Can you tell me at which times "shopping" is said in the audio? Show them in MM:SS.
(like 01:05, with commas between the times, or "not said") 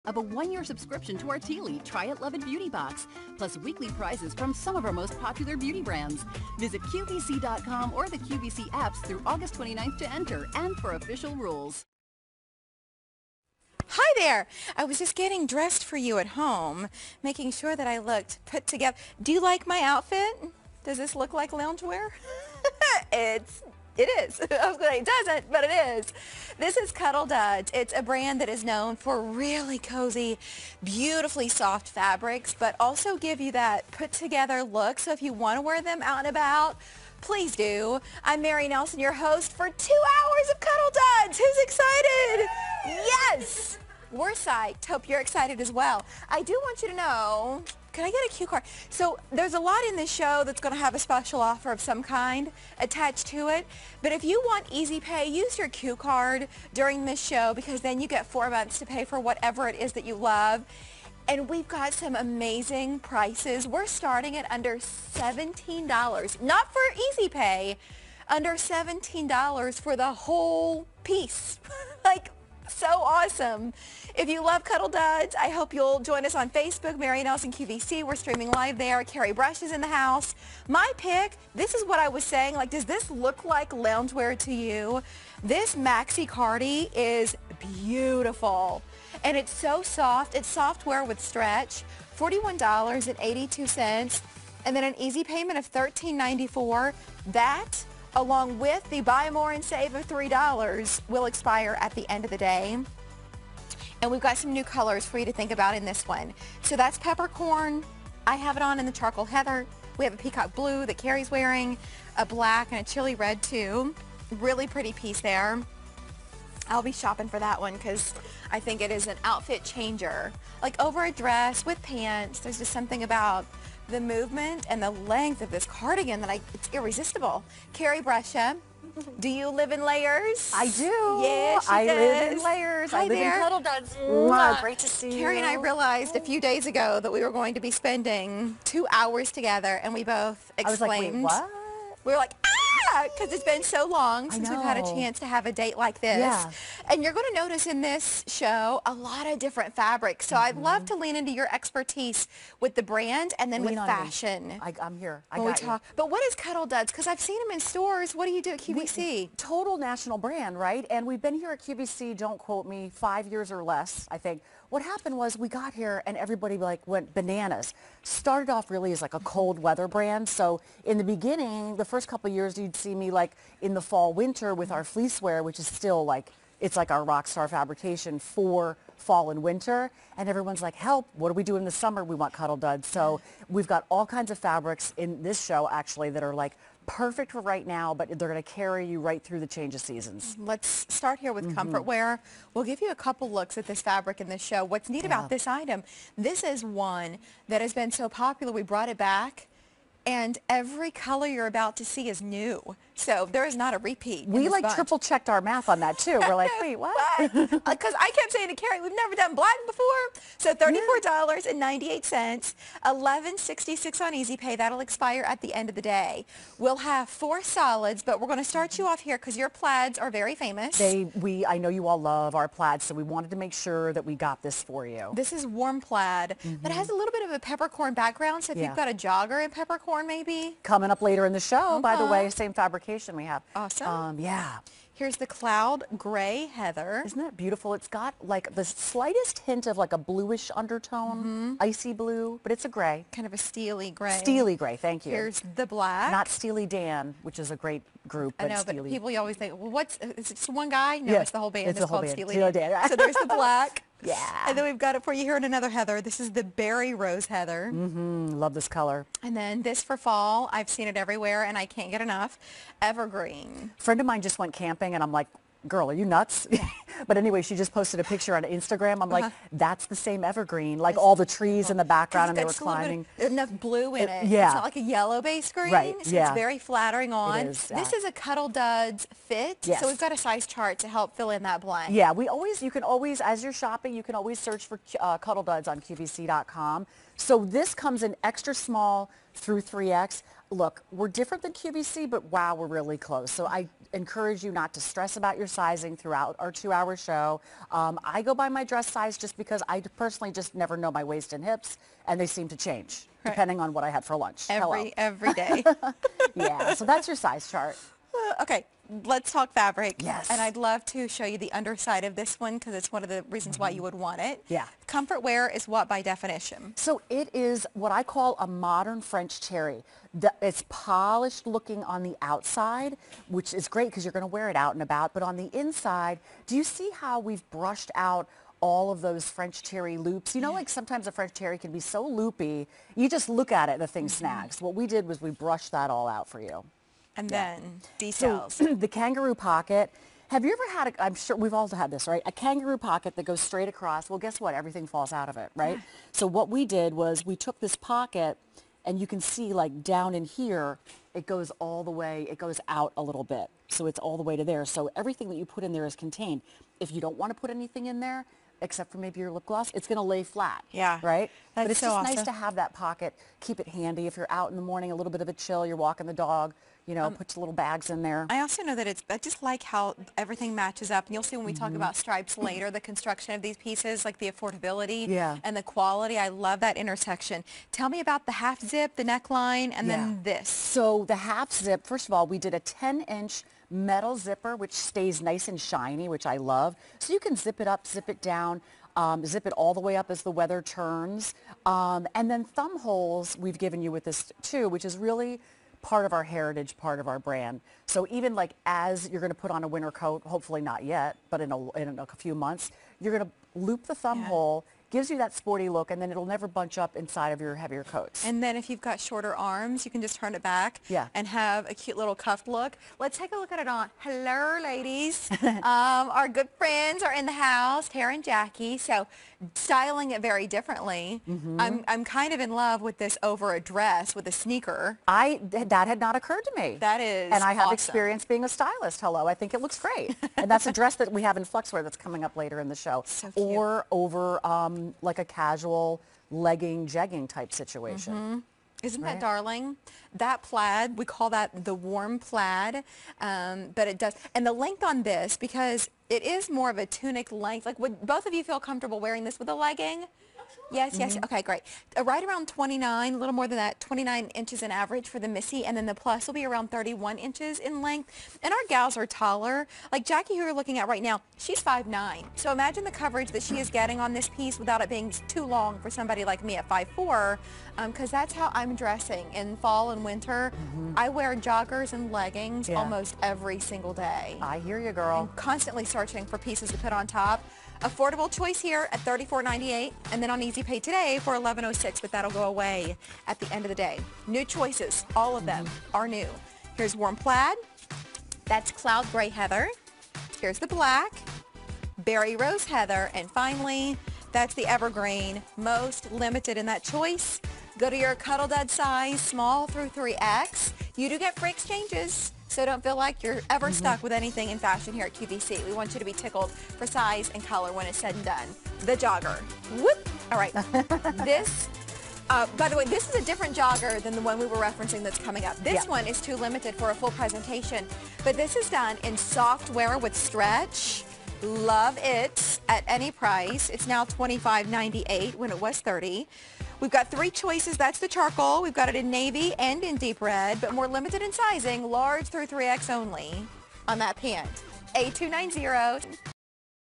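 01:56, 04:43.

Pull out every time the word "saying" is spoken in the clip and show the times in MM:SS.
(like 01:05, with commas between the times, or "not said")
01:22, 03:28.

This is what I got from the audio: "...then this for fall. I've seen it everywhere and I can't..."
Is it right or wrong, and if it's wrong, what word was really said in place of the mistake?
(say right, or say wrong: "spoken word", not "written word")
right.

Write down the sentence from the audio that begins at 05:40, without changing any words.
Have you ever had a, I'm sure we've all had this, right?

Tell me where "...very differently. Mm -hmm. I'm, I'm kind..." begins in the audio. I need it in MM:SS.
07:00.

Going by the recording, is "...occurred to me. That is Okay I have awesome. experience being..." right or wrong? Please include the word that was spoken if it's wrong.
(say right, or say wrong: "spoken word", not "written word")
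wrong: "And", not "Okay".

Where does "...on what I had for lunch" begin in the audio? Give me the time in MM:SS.
05:03.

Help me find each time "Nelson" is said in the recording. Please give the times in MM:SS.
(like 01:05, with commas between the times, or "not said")
00:38, 01:17.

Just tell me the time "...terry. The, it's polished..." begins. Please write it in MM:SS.
05:19.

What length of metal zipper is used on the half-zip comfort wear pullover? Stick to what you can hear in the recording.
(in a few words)
10-inch.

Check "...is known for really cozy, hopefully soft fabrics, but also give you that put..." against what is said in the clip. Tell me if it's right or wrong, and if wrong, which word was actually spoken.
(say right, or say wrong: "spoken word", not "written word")
wrong: "beautifully", not "hopefully".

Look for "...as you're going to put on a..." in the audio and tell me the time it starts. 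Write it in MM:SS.
06:38.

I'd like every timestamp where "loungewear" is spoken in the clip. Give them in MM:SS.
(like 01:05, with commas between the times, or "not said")
00:21, 01:23.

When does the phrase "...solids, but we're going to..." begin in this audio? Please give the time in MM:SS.
03:37.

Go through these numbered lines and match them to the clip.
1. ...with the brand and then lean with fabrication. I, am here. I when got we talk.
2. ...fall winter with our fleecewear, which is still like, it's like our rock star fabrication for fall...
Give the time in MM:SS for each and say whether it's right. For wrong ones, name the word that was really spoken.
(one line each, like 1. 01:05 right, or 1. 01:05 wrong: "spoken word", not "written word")
1. 02:32 wrong: "fashion", not "fabrication"
2. 02:53 right.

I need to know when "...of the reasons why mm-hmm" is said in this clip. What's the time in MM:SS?
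05:13.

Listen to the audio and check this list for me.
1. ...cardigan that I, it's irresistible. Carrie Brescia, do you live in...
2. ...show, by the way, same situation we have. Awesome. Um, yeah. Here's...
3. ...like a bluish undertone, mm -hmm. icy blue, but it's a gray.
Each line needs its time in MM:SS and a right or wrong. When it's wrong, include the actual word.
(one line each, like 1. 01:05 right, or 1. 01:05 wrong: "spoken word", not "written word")
1. 02:05 right
2. 03:51 wrong: "fabrication", not "situation"
3. 03:59 right.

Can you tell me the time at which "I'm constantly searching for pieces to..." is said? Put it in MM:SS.
07:55.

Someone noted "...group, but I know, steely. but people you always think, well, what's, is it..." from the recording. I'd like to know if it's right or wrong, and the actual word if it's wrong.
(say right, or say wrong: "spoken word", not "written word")
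right.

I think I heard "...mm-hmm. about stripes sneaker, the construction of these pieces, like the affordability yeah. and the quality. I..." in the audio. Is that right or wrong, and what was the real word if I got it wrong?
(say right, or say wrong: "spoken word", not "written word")
wrong: "later", not "sneaker".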